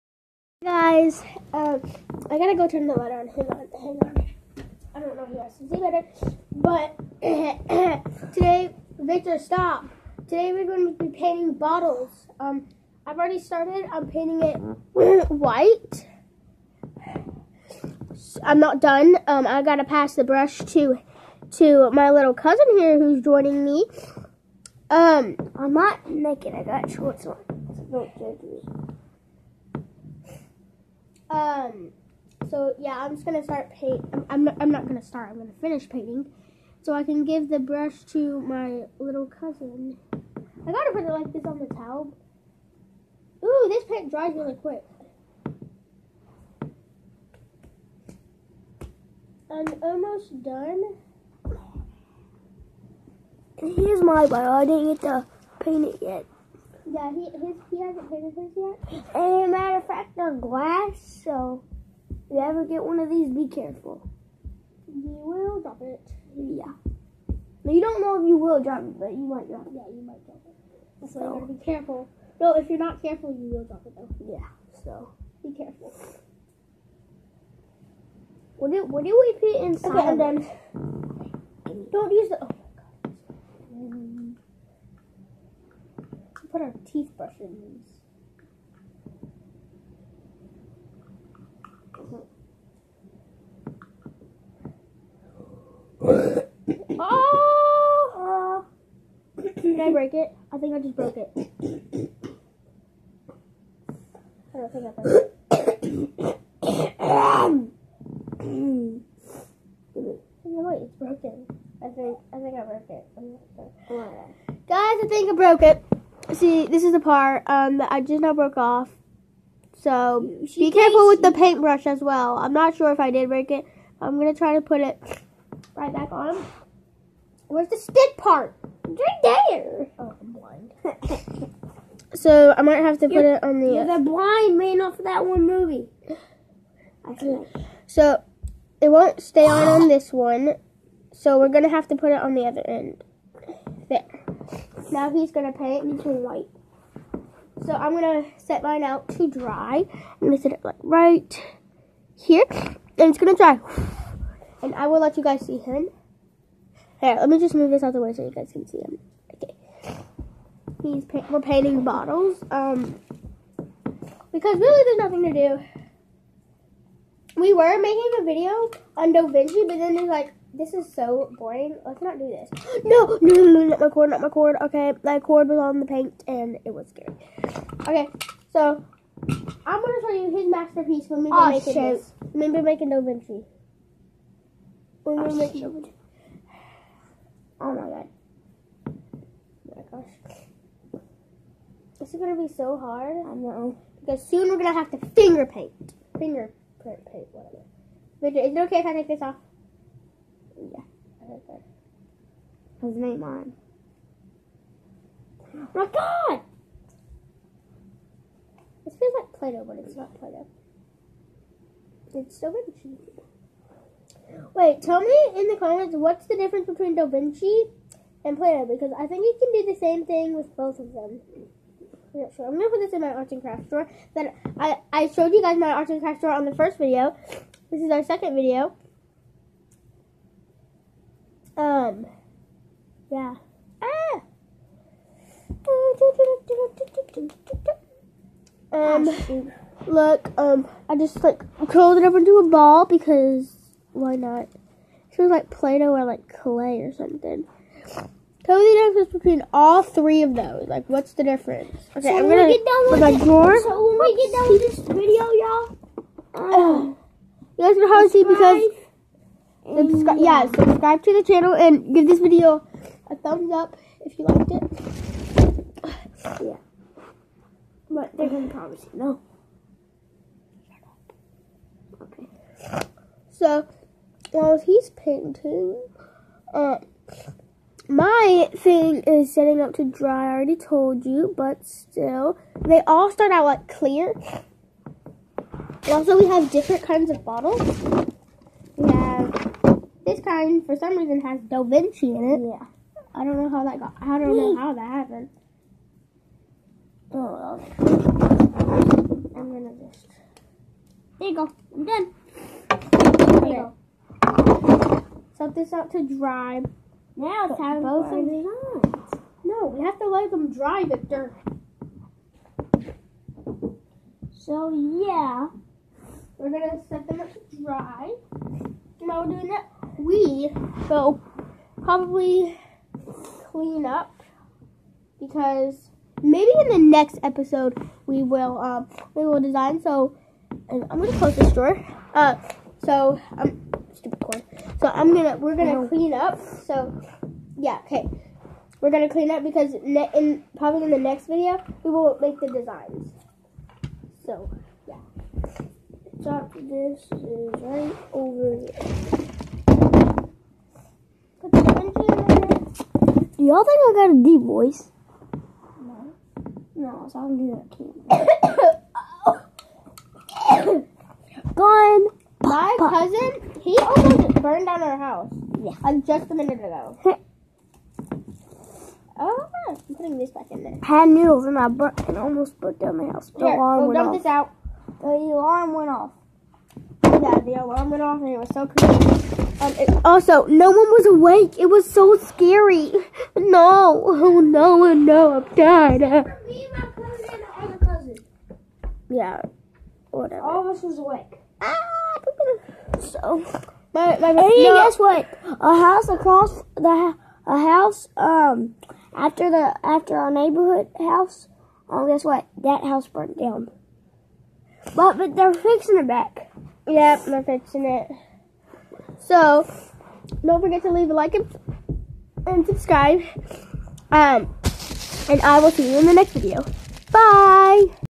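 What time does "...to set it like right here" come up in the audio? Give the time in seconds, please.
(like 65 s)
150 s.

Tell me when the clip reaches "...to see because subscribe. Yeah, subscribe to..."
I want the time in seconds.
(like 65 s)
258 s.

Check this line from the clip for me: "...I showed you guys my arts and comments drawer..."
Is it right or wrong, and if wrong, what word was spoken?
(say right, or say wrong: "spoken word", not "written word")
wrong: "crafts", not "comments".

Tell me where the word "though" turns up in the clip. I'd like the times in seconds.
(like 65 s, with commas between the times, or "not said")
73 s.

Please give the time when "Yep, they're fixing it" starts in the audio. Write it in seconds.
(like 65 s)
406 s.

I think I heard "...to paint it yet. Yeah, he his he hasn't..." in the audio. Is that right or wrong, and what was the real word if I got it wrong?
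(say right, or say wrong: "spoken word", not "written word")
right.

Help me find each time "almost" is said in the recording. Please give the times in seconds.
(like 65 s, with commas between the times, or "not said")
49 s, 363 s, 372 s.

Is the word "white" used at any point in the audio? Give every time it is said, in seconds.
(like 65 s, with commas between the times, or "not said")
15 s, 146 s.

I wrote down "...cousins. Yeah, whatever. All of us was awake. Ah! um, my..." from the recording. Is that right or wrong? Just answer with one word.
right.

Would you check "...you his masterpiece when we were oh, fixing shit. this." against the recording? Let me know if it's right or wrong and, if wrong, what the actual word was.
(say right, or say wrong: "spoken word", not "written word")
wrong: "making", not "fixing".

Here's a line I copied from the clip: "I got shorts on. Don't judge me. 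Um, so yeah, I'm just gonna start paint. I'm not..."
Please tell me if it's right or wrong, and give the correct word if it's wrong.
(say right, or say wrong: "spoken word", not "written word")
right.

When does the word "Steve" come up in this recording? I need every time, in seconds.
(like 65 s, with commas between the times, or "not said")
not said.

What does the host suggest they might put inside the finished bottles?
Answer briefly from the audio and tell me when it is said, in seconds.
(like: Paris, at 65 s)
Toothbrush, at 86 s.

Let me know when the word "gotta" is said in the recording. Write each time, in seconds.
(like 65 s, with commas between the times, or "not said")
2 s, 19 s, 40 s, 71 s.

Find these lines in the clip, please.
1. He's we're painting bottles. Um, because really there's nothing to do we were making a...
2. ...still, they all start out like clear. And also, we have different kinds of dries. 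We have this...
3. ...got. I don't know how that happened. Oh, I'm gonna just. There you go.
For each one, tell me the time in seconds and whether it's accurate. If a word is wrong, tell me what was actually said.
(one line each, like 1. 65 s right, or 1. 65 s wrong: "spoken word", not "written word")
1. 160 s right
2. 281 s wrong: "bottles", not "dries"
3. 293 s right.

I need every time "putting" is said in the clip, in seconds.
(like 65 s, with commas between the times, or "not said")
369 s.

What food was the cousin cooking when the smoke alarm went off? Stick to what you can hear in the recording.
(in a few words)
Noodles.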